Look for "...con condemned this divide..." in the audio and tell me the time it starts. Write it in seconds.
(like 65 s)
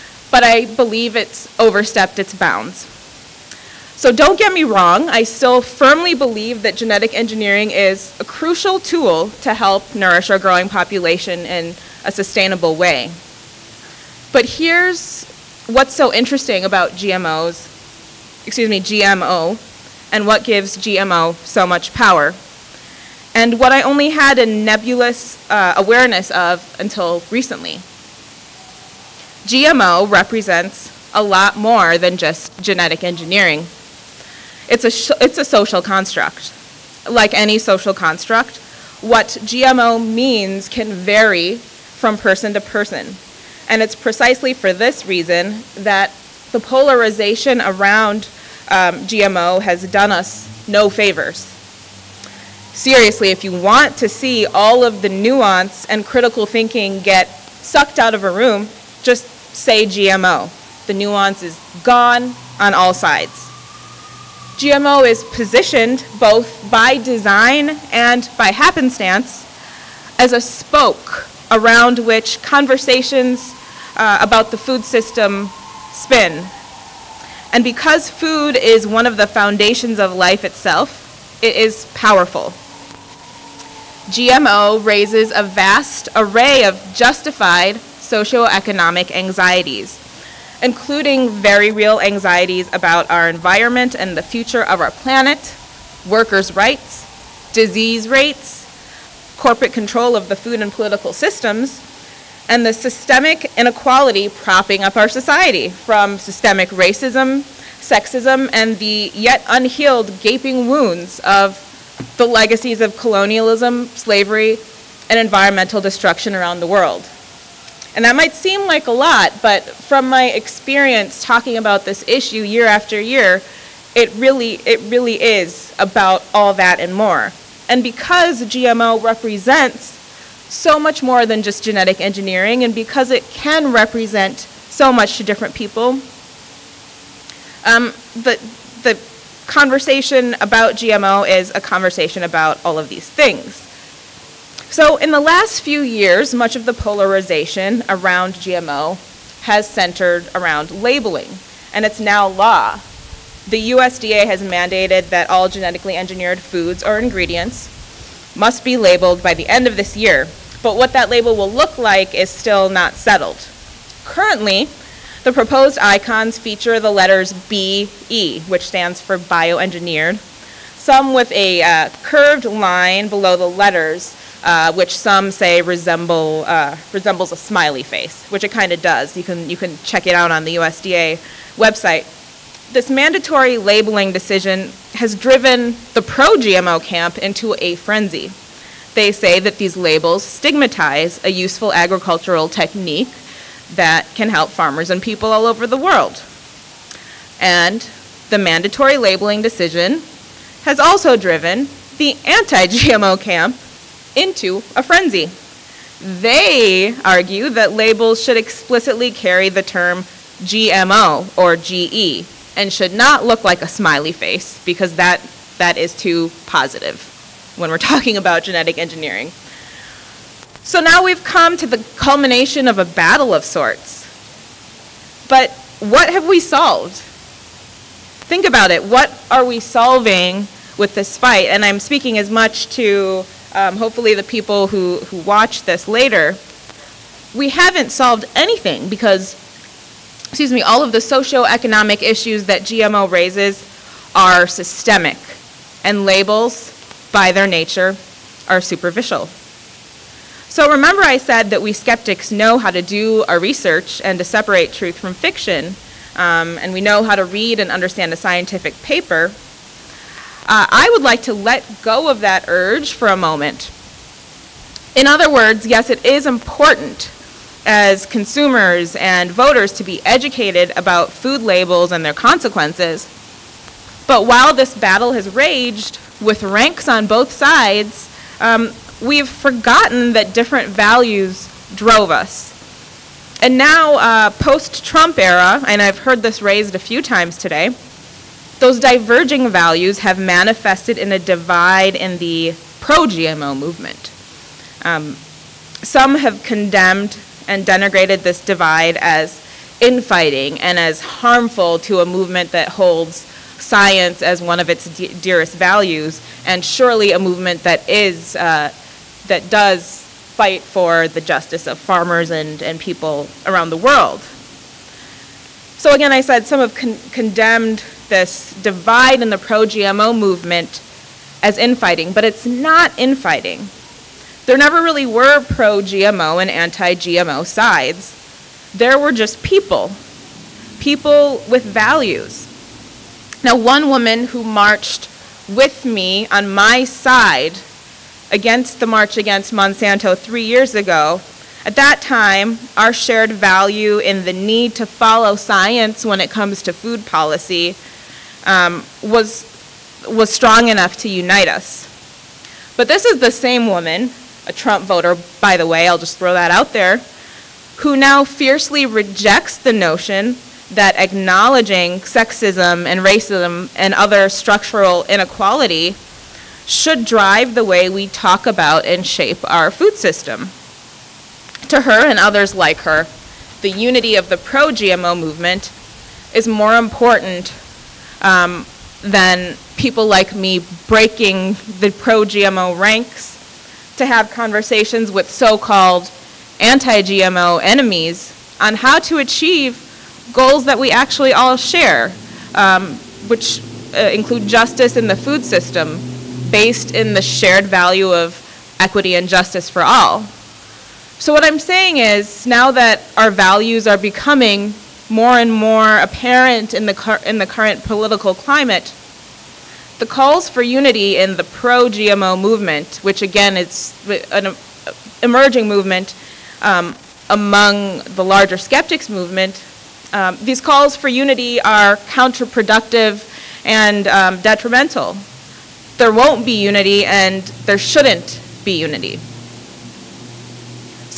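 316 s.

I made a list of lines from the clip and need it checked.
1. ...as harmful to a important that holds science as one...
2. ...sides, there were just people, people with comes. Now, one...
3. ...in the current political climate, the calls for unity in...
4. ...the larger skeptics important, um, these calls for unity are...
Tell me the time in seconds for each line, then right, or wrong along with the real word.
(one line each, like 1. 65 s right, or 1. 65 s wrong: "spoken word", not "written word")
1. 300 s wrong: "movement", not "important"
2. 327 s wrong: "values", not "comes"
3. 407 s right
4. 418 s wrong: "movement", not "important".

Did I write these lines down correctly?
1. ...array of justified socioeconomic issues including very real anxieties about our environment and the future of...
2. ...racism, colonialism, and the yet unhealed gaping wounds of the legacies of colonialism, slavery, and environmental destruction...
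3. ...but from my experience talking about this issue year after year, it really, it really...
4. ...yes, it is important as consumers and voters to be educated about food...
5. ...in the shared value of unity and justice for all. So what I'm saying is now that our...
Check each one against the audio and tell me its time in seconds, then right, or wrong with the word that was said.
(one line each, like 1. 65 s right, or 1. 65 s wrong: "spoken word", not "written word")
1. 86 s wrong: "anxieties", not "issues"
2. 106 s wrong: "sexism", not "colonialism"
3. 119 s right
4. 265 s right
5. 396 s wrong: "equity", not "unity".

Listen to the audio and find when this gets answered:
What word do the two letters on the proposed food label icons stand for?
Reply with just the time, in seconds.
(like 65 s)
169 s.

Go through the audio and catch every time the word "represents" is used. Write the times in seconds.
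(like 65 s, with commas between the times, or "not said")
30 s, 129 s, 133 s.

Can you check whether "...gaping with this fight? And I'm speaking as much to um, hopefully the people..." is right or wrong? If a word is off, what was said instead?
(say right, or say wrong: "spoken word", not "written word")
wrong: "solving", not "gaping".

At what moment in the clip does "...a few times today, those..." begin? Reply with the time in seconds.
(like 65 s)
286 s.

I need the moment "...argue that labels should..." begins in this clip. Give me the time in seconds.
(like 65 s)
207 s.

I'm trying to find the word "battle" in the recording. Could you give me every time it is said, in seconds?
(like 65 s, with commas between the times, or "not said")
222 s, 274 s.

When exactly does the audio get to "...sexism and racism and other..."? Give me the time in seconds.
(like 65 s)
362 s.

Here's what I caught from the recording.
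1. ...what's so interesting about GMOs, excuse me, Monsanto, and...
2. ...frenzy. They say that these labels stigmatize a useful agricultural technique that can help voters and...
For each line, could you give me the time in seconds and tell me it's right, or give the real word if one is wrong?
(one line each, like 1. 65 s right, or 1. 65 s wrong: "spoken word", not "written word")
1. 15 s wrong: "GMO", not "Monsanto"
2. 187 s wrong: "farmers", not "voters".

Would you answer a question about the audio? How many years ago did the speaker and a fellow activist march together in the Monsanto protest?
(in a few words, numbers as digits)
3.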